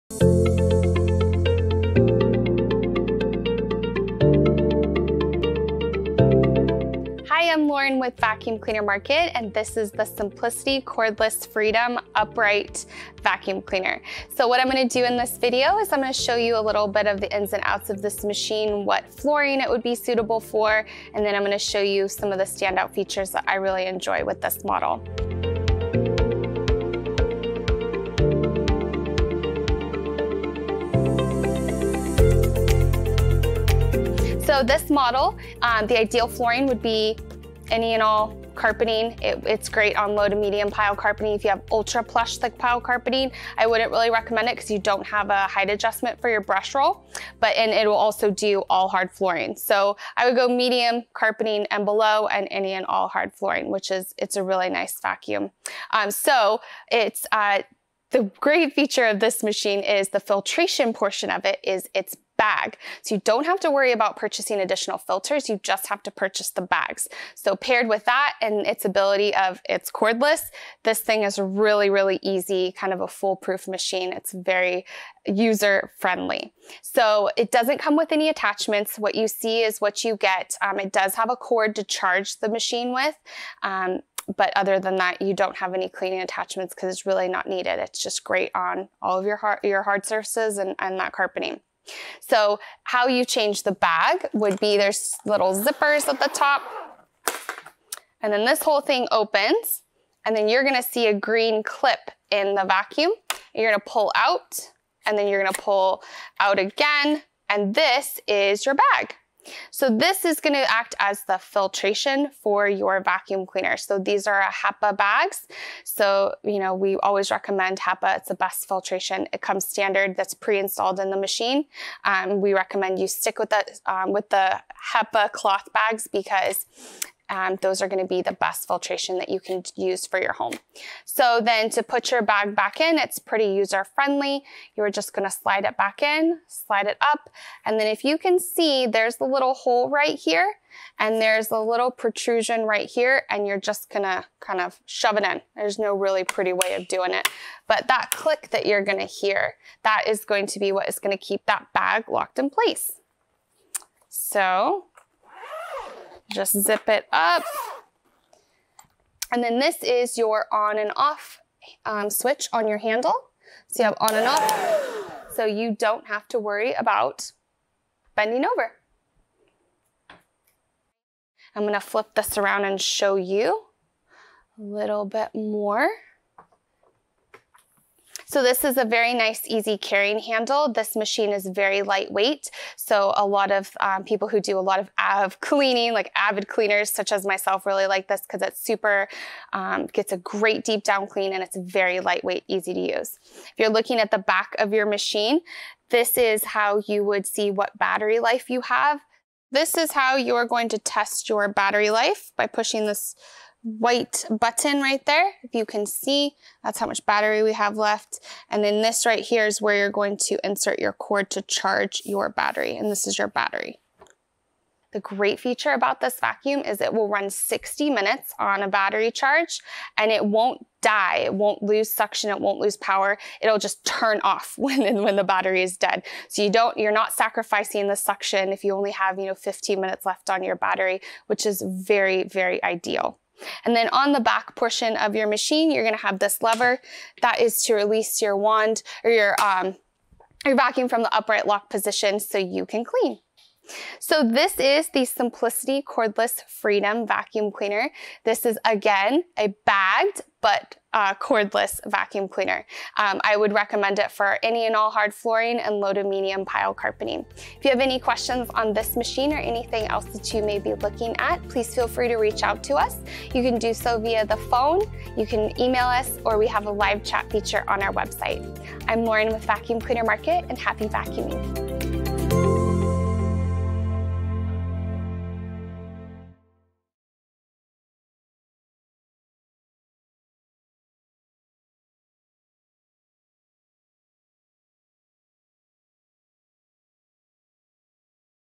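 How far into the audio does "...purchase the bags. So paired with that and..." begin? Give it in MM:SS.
01:06.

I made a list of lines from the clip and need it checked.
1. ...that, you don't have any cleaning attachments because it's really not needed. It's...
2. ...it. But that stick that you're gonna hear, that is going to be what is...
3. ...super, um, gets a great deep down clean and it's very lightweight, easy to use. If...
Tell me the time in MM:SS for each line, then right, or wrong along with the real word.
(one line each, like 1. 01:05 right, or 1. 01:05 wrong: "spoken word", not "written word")
1. 01:24 right
2. 02:27 wrong: "click", not "stick"
3. 03:08 right.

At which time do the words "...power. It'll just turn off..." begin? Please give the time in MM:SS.
03:42.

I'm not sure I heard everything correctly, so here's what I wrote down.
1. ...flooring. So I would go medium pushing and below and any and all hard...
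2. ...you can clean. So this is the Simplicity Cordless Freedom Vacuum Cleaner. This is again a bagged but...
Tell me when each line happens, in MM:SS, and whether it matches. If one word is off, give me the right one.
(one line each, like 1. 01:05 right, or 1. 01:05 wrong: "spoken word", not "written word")
1. 00:49 wrong: "carpeting", not "pushing"
2. 04:02 right.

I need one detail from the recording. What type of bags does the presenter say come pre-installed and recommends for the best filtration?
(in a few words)
HEPA cloth bags.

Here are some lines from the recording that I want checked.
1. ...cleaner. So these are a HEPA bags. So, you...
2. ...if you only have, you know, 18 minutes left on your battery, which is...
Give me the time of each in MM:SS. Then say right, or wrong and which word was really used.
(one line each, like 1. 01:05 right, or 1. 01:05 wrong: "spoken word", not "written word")
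1. 01:53 right
2. 03:48 wrong: "15", not "18".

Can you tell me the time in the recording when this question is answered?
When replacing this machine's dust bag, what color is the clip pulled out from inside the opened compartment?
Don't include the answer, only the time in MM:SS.
01:41.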